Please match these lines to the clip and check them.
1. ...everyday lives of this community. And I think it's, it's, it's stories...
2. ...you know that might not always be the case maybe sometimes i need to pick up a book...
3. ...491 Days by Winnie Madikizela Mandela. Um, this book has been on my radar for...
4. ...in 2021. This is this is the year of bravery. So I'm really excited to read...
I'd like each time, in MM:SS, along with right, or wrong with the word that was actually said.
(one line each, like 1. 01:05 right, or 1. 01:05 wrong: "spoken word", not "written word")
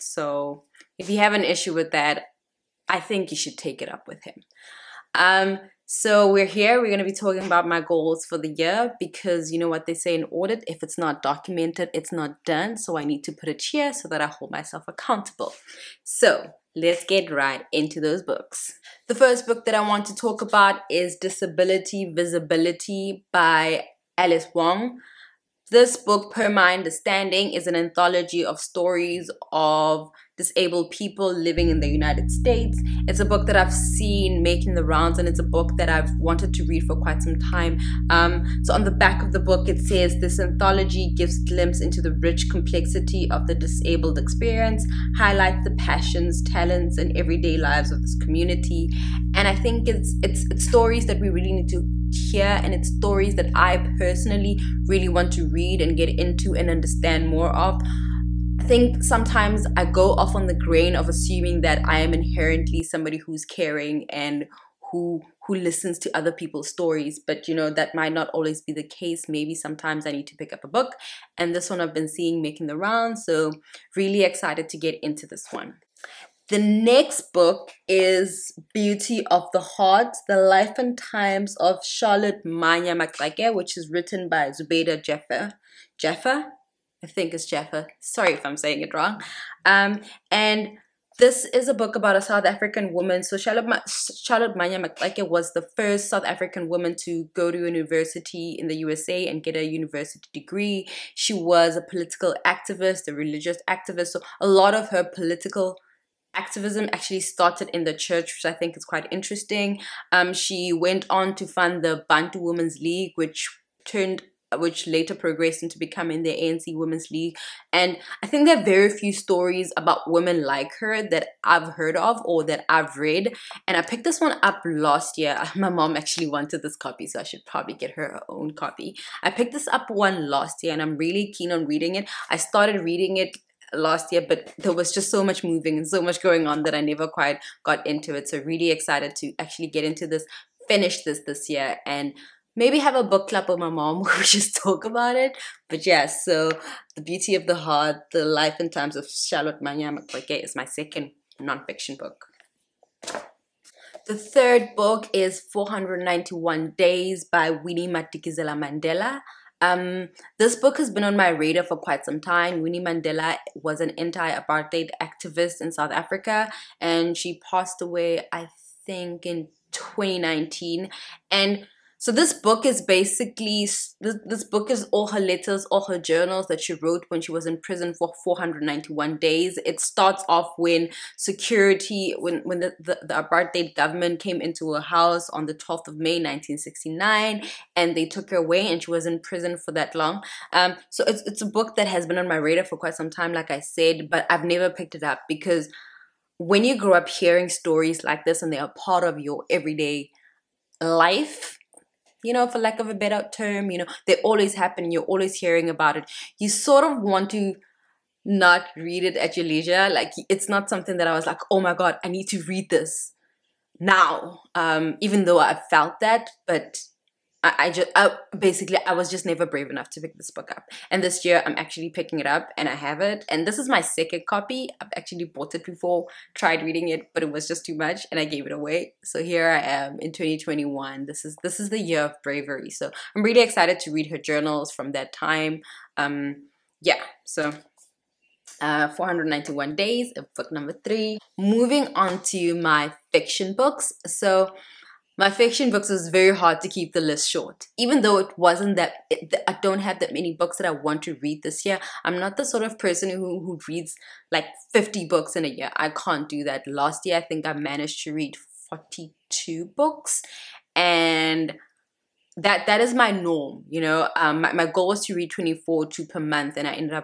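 1. 00:47 right
2. 01:07 right
3. 02:35 right
4. 03:50 right.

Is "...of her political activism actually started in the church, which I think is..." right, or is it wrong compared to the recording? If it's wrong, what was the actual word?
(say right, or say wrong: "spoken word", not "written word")
right.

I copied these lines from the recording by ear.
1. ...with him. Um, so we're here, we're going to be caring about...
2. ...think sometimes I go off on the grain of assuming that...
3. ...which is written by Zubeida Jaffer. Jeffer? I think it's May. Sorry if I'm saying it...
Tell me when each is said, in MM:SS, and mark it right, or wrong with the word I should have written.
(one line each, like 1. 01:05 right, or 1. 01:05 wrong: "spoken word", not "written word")
1. 00:04 wrong: "talking", not "caring"
2. 00:58 right
3. 01:23 wrong: "Jeffer", not "May".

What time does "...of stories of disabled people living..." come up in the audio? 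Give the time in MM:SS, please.
00:28.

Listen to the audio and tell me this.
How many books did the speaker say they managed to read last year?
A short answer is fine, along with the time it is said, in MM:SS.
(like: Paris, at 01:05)
42, at 04:18.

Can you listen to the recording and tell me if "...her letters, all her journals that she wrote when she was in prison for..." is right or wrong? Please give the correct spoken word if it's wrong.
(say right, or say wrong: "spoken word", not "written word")
right.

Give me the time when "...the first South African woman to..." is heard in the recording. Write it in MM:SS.
01:35.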